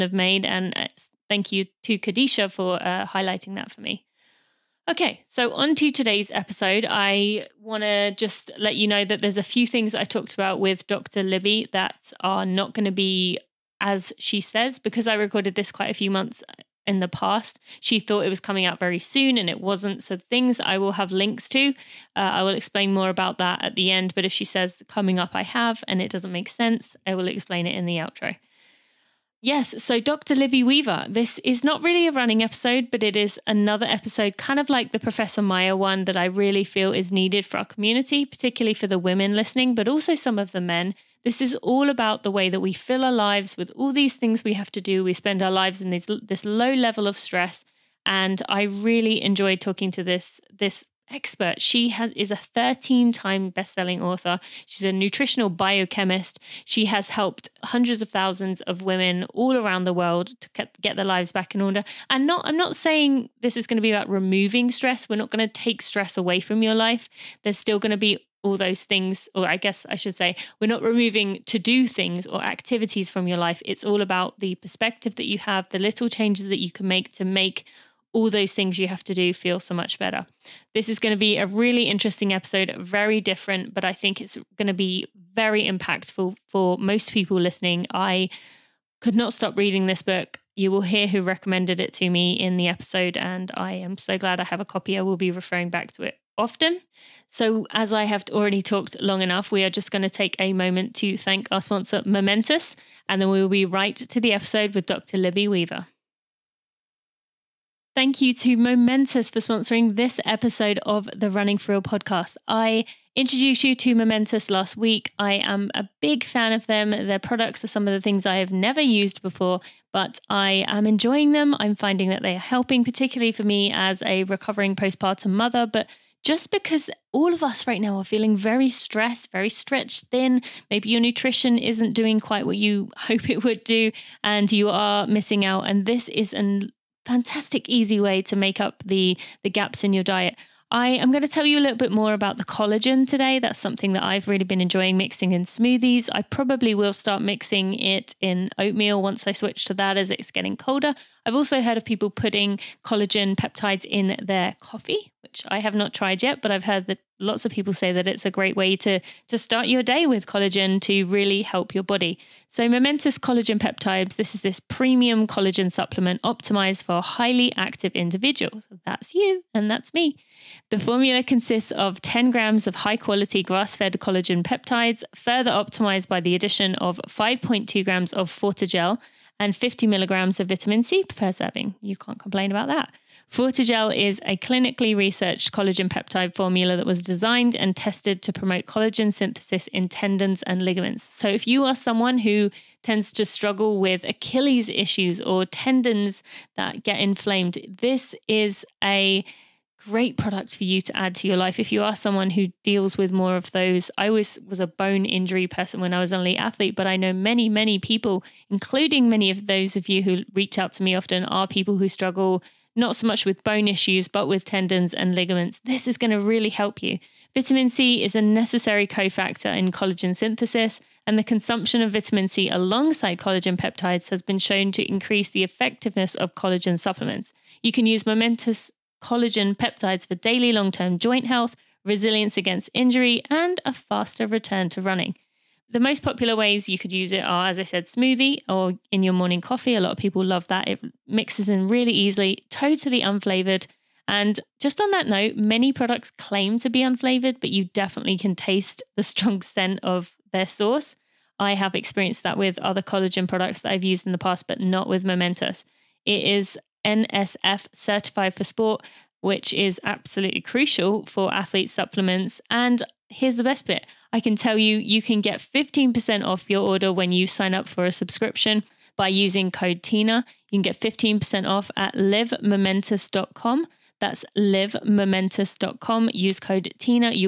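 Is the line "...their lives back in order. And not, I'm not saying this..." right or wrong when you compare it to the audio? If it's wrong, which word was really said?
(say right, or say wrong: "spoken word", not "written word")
right.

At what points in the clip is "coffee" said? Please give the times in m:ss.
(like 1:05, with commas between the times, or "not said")
2:34, 3:59.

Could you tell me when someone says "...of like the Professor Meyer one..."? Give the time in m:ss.
0:34.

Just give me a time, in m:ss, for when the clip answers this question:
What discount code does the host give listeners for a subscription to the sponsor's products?
4:29.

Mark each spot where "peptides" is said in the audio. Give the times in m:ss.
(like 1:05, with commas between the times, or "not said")
2:33, 2:43, 2:54, 3:05, 3:43, 3:49.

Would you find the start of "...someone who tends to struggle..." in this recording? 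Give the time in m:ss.
3:11.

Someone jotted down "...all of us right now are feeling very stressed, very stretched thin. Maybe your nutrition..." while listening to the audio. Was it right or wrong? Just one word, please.
right.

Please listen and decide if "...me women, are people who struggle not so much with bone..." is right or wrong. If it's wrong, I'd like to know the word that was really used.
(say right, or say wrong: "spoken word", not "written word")
wrong: "often", not "women".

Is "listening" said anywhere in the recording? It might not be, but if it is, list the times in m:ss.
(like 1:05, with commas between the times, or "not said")
0:39, 1:27.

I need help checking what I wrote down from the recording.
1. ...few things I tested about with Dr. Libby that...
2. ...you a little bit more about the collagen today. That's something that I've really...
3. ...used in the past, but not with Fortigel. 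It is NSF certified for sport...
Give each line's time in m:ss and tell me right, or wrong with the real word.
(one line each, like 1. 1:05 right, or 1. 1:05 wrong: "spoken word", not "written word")
1. 0:09 wrong: "talked", not "tested"
2. 2:21 right
3. 4:13 wrong: "Momentous", not "Fortigel".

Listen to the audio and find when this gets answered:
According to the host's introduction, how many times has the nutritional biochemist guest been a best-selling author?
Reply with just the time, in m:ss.
0:52.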